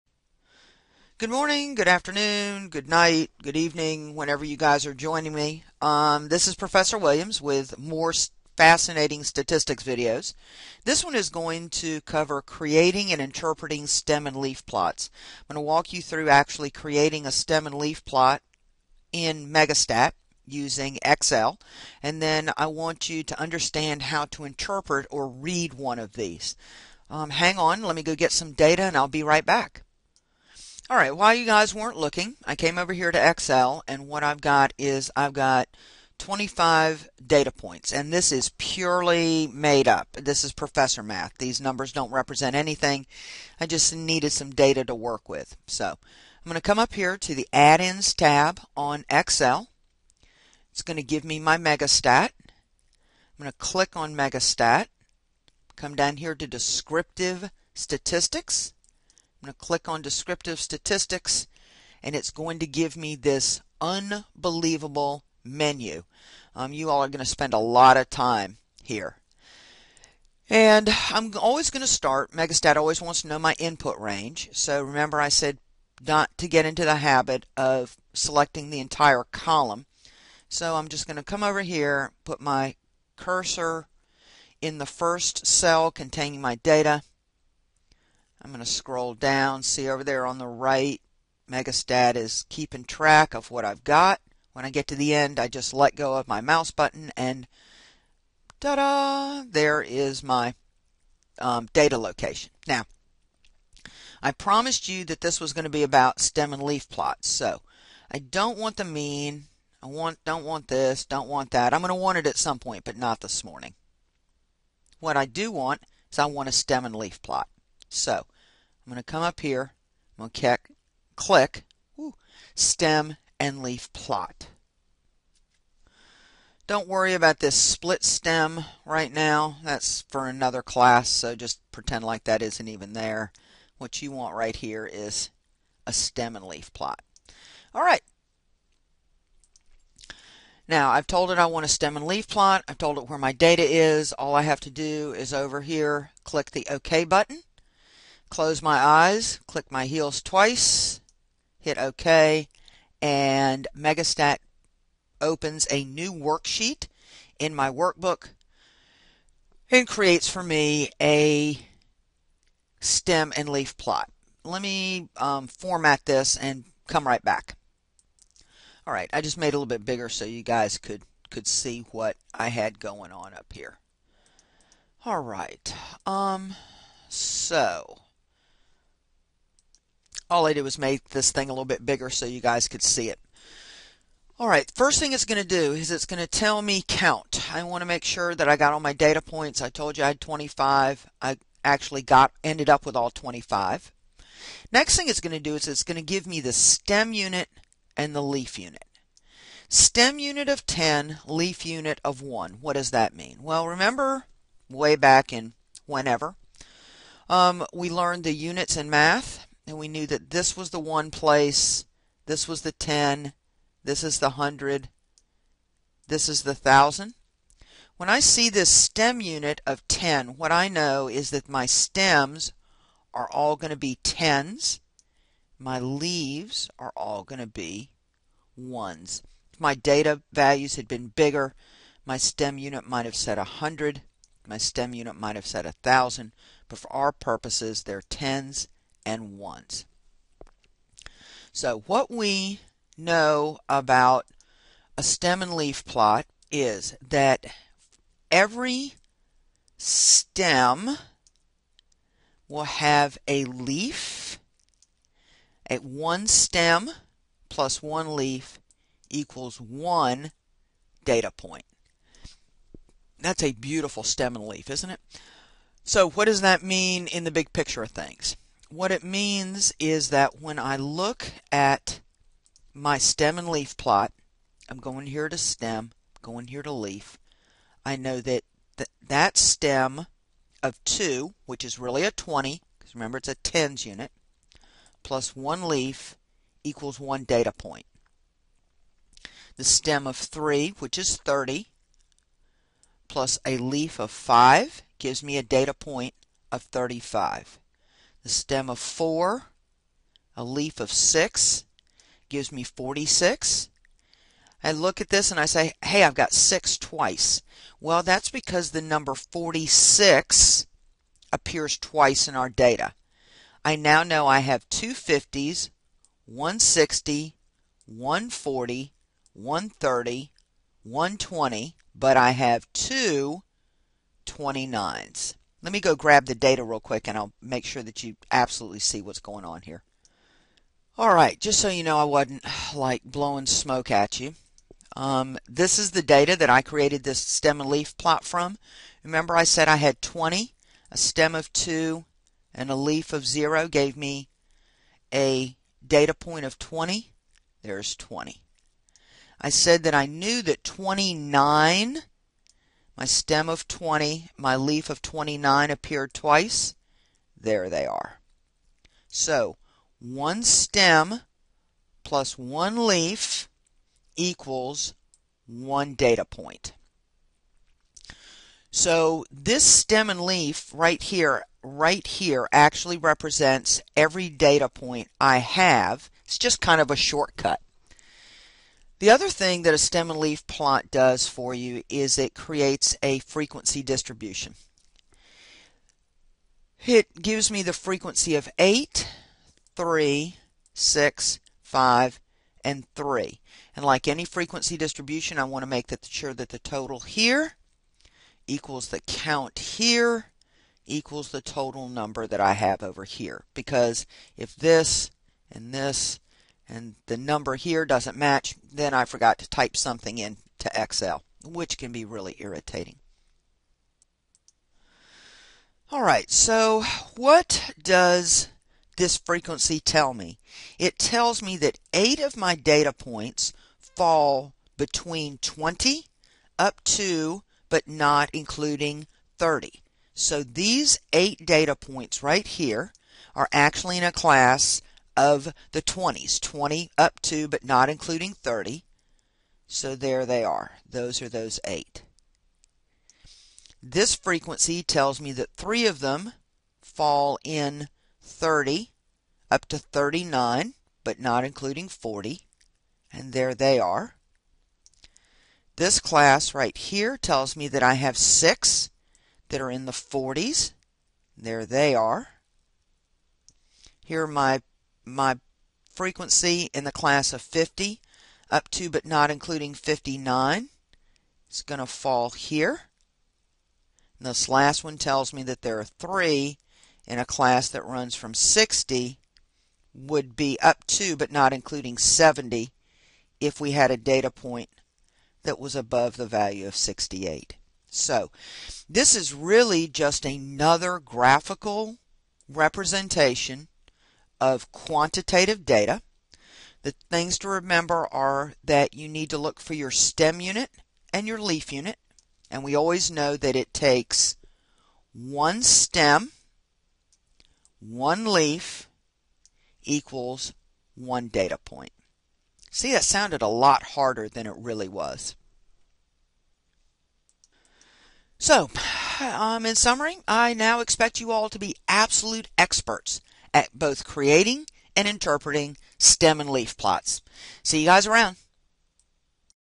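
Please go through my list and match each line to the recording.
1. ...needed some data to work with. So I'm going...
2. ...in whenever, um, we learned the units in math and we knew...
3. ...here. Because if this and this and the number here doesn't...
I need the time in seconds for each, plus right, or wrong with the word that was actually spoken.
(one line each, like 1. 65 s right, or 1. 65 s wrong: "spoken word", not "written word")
1. 43 s right
2. 205 s right
3. 403 s right.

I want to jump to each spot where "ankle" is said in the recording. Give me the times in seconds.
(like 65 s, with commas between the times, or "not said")
not said.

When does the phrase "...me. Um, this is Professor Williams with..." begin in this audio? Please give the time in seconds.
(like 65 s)
5 s.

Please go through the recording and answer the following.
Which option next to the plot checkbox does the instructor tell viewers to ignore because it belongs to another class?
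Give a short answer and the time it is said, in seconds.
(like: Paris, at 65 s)
split stem, at 127 s.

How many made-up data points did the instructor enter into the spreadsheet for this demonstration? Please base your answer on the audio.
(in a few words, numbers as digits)
25.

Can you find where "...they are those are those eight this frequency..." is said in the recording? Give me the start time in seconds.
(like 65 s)
440 s.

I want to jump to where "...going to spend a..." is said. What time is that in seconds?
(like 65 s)
67 s.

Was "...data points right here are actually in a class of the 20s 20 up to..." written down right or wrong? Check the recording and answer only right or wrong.
right.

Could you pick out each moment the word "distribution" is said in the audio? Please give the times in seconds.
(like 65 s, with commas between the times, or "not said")
383 s, 394 s.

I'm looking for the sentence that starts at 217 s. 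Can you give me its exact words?
When I see this stem unit of 10, what I know is that my stems are all going to be 10s.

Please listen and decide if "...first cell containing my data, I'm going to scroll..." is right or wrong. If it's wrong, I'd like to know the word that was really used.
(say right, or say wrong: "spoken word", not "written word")
right.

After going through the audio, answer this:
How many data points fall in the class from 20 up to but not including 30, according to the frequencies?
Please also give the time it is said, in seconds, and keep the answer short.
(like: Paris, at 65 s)
8, at 421 s.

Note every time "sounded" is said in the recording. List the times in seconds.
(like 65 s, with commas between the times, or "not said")
513 s.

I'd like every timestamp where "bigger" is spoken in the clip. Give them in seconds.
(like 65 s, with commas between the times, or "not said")
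169 s, 181 s, 231 s.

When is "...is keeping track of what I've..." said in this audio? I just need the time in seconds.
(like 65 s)
92 s.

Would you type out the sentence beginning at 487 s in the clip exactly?
So this is really just another graphical representation of quantitative data.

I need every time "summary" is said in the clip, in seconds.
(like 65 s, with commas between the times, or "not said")
519 s.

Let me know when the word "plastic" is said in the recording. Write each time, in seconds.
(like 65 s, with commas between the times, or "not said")
not said.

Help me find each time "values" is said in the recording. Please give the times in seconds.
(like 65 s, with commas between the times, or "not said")
230 s, 486 s.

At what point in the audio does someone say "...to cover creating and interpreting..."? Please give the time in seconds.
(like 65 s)
11 s.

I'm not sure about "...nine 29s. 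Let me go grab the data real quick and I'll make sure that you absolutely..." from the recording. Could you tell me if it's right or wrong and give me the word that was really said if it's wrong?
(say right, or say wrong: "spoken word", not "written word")
wrong: "two", not "nine".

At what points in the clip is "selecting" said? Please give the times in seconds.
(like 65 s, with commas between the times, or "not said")
78 s.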